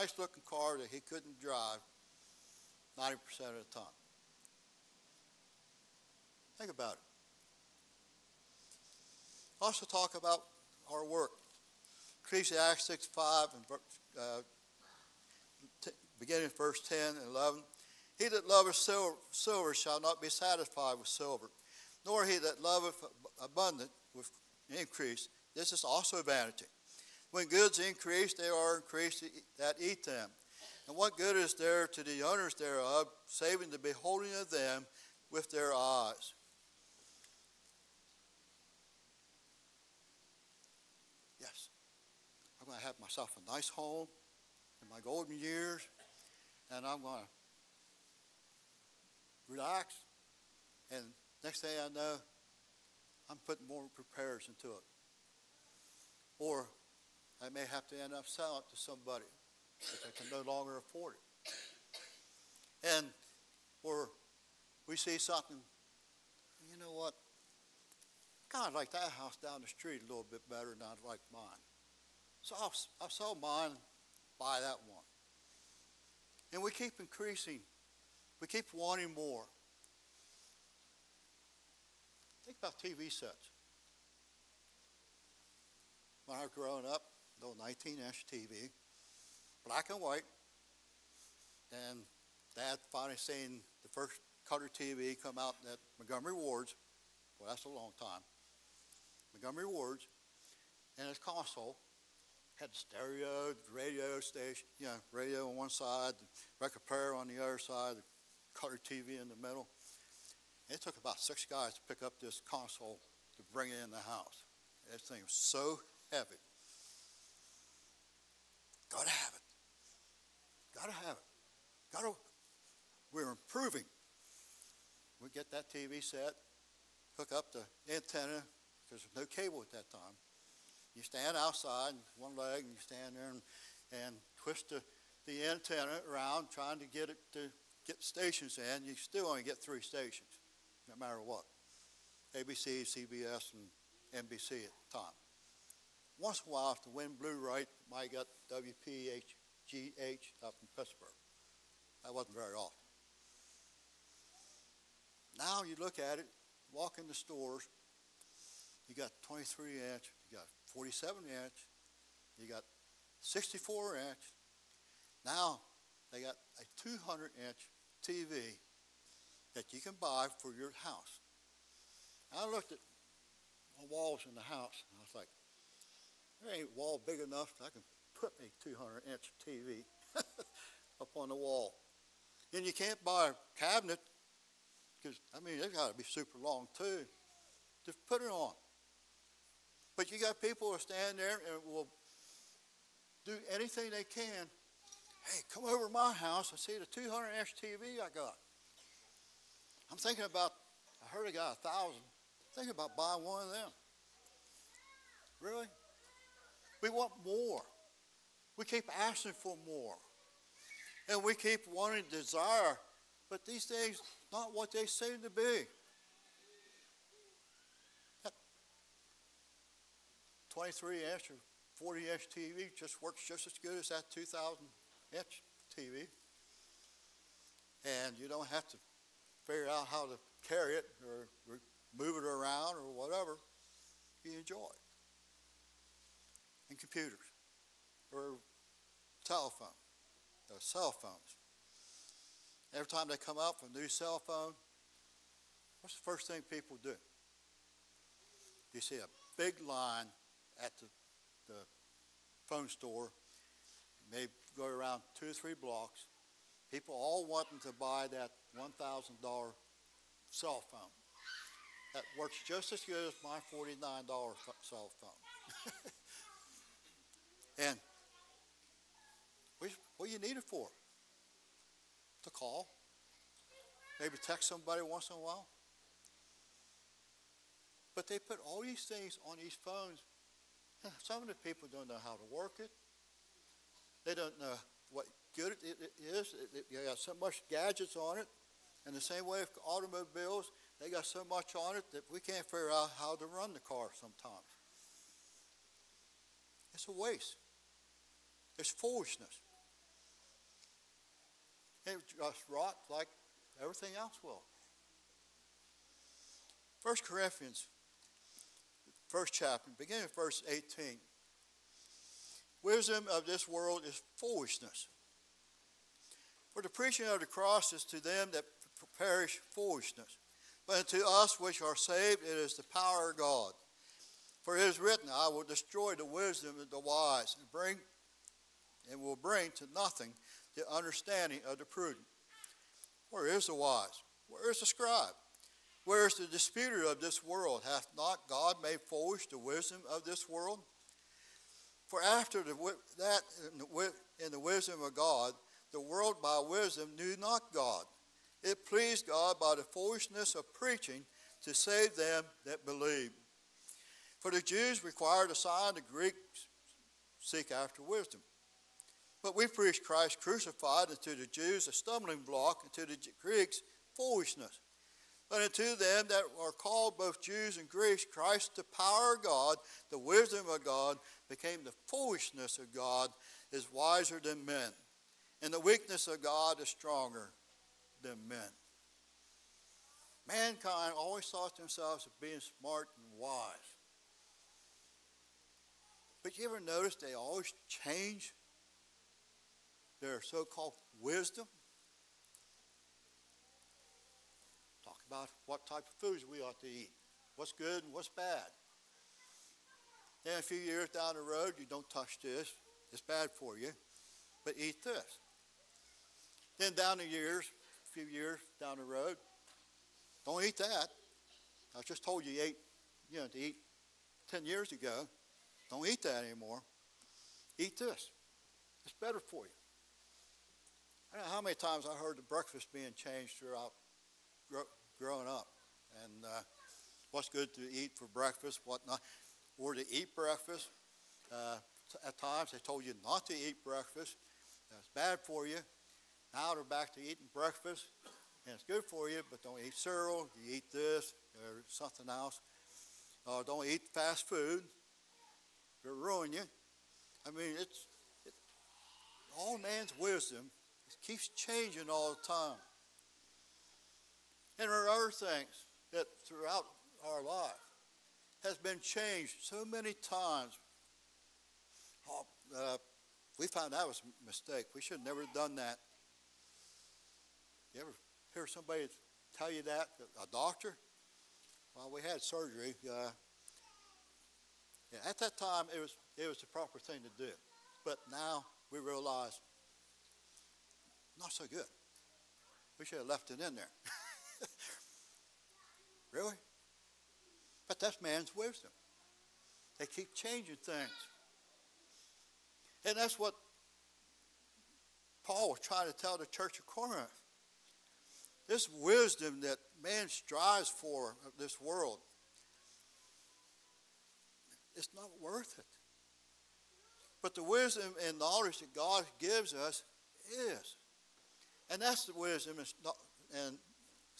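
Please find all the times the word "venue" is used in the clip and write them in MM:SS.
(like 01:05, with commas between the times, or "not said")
not said.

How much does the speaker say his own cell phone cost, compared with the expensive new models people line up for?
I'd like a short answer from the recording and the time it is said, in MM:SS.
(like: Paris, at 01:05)
$49, at 04:23.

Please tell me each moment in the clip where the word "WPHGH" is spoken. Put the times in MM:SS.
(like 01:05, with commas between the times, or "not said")
02:28.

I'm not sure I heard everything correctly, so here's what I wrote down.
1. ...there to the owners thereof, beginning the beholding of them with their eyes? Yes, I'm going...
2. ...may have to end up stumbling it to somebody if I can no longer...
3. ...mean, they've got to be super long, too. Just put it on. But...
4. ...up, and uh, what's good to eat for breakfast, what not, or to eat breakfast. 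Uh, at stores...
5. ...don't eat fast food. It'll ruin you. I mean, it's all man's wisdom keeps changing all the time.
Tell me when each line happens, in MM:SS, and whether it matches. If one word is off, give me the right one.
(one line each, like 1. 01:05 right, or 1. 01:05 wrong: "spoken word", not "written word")
1. 00:31 wrong: "saving", not "beginning"
2. 00:57 wrong: "selling", not "stumbling"
3. 03:05 right
4. 07:05 wrong: "times", not "stores"
5. 07:23 right.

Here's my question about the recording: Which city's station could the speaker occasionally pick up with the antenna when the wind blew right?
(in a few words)
Pittsburgh.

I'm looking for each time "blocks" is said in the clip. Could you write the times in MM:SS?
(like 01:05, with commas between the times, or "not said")
04:15, 06:02.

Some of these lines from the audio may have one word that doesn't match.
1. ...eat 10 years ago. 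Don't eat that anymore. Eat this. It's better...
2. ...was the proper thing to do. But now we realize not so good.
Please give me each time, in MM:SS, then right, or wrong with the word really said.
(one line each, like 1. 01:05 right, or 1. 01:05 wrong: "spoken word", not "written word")
1. 06:53 right
2. 07:56 right.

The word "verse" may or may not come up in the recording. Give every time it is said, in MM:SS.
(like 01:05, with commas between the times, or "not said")
00:16, 05:10.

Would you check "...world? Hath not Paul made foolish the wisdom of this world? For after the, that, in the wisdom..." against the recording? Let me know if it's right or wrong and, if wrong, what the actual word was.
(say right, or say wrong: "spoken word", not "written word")
wrong: "God", not "Paul".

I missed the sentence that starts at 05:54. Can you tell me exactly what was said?
For the Jews required a sign, the Greeks seek after wisdom.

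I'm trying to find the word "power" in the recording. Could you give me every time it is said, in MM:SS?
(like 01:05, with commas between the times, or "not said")
05:22, 06:08.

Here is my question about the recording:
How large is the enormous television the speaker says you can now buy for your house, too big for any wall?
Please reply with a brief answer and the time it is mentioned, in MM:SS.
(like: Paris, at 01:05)
200 inch, at 02:46.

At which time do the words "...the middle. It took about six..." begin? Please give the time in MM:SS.
01:49.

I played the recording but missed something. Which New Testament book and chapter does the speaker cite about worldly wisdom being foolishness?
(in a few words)
1 Corinthians 1.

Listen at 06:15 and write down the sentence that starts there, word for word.
And the weakness of God is stronger than men.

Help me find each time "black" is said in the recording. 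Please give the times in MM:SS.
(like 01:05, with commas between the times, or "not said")
01:29.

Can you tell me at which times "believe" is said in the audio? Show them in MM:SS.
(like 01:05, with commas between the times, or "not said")
05:52.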